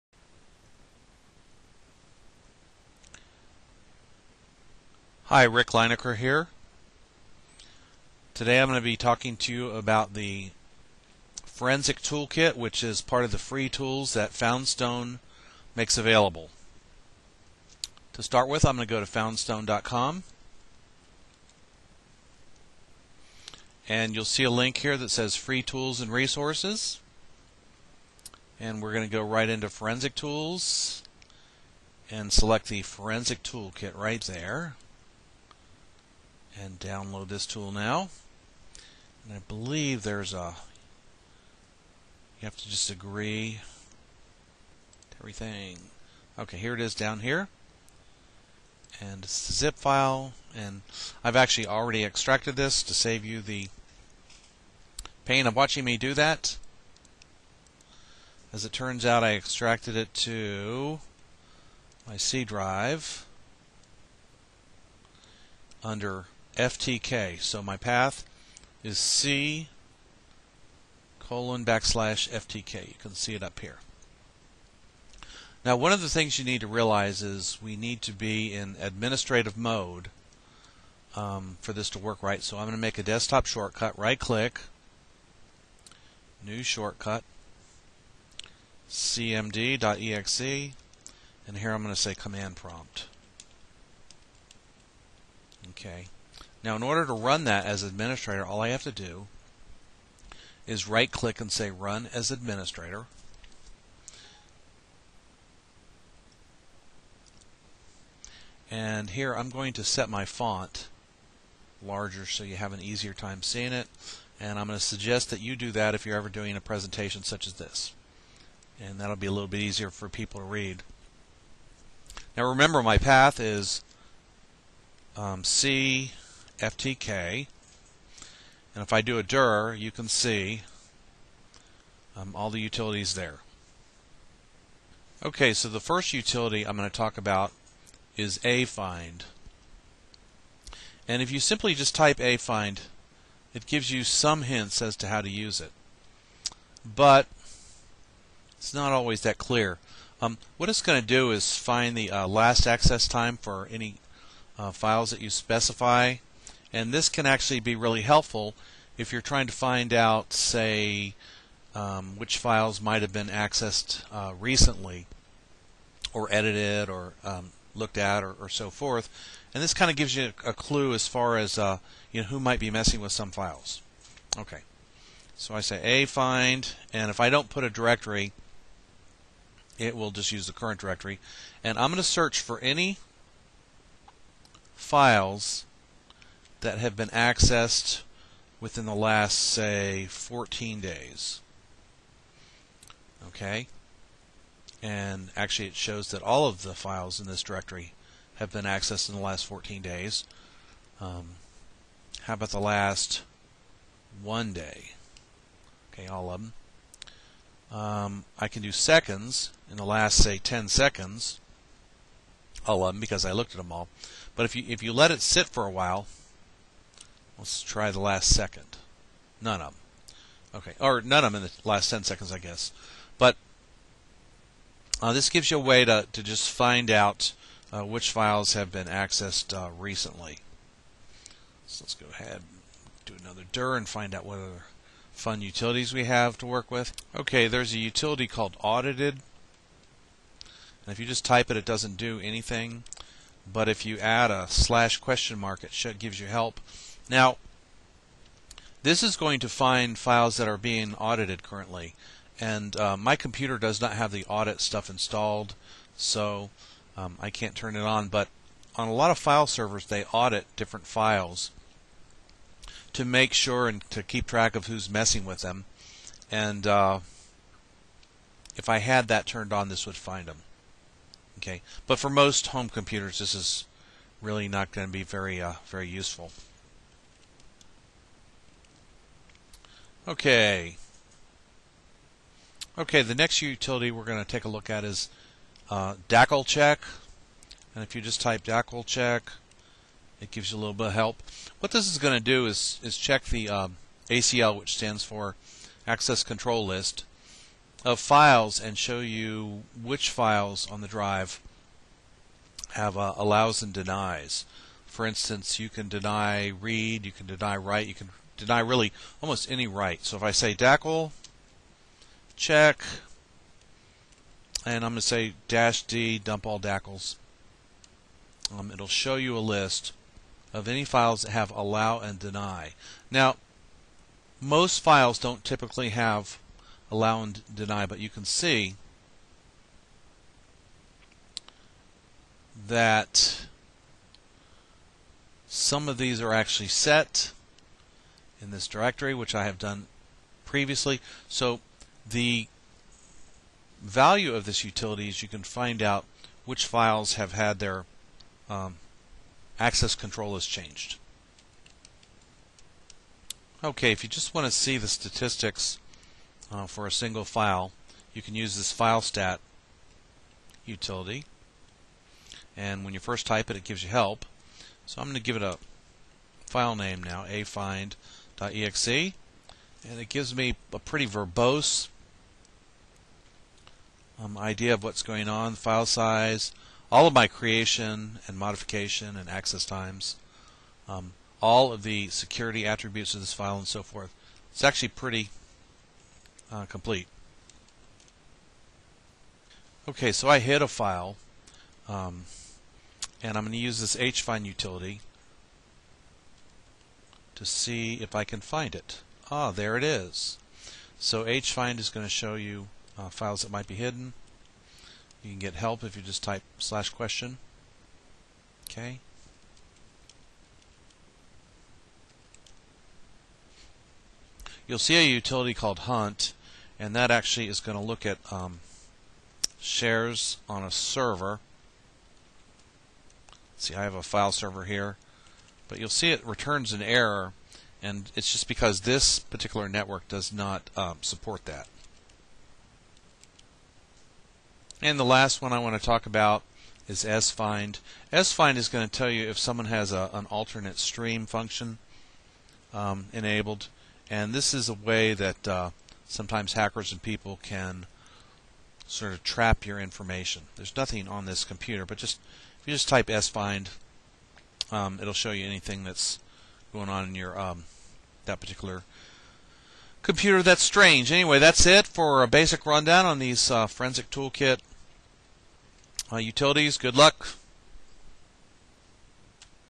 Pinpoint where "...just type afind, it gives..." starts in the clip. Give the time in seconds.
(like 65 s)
141 s.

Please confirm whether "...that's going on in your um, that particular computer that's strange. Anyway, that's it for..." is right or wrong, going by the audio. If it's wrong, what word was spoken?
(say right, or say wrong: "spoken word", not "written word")
right.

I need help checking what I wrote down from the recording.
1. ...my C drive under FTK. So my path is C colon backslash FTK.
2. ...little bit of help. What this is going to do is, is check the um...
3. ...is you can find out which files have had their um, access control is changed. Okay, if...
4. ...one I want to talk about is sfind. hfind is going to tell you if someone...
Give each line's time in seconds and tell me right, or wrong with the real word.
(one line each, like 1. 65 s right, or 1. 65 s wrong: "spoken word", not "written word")
1. 62 s right
2. 290 s right
3. 345 s right
4. 435 s wrong: "sfind", not "hfind".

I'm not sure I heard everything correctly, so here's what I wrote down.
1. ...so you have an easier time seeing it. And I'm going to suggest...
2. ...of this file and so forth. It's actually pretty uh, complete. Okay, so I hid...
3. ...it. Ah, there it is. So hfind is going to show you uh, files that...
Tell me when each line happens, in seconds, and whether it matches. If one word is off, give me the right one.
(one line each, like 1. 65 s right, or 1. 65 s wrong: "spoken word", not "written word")
1. 112 s right
2. 383 s right
3. 398 s right.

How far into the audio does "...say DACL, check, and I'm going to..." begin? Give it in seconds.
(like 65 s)
310 s.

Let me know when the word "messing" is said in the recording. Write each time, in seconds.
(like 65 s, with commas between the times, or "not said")
172 s, 264 s.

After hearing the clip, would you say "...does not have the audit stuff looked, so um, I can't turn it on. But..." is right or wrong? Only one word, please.
wrong.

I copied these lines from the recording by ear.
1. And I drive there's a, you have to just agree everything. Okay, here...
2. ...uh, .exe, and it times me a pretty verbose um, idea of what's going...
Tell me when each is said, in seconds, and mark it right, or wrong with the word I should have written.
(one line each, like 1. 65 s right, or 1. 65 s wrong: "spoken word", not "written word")
1. 39 s wrong: "believe", not "drive"
2. 368 s wrong: "gives", not "times".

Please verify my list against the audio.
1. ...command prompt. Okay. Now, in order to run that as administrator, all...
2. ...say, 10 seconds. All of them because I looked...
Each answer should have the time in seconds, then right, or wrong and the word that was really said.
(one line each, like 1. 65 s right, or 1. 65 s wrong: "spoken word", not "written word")
1. 92 s right
2. 210 s right.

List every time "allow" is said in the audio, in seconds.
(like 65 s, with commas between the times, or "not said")
303 s, 321 s, 326 s.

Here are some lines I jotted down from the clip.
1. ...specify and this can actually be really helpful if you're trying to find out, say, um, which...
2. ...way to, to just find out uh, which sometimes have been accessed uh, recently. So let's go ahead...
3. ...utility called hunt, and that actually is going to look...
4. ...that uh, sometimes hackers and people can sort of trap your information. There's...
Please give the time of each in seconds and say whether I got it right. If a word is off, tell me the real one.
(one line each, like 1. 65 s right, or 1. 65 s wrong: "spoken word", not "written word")
1. 155 s right
2. 225 s wrong: "files", not "sometimes"
3. 415 s right
4. 445 s right.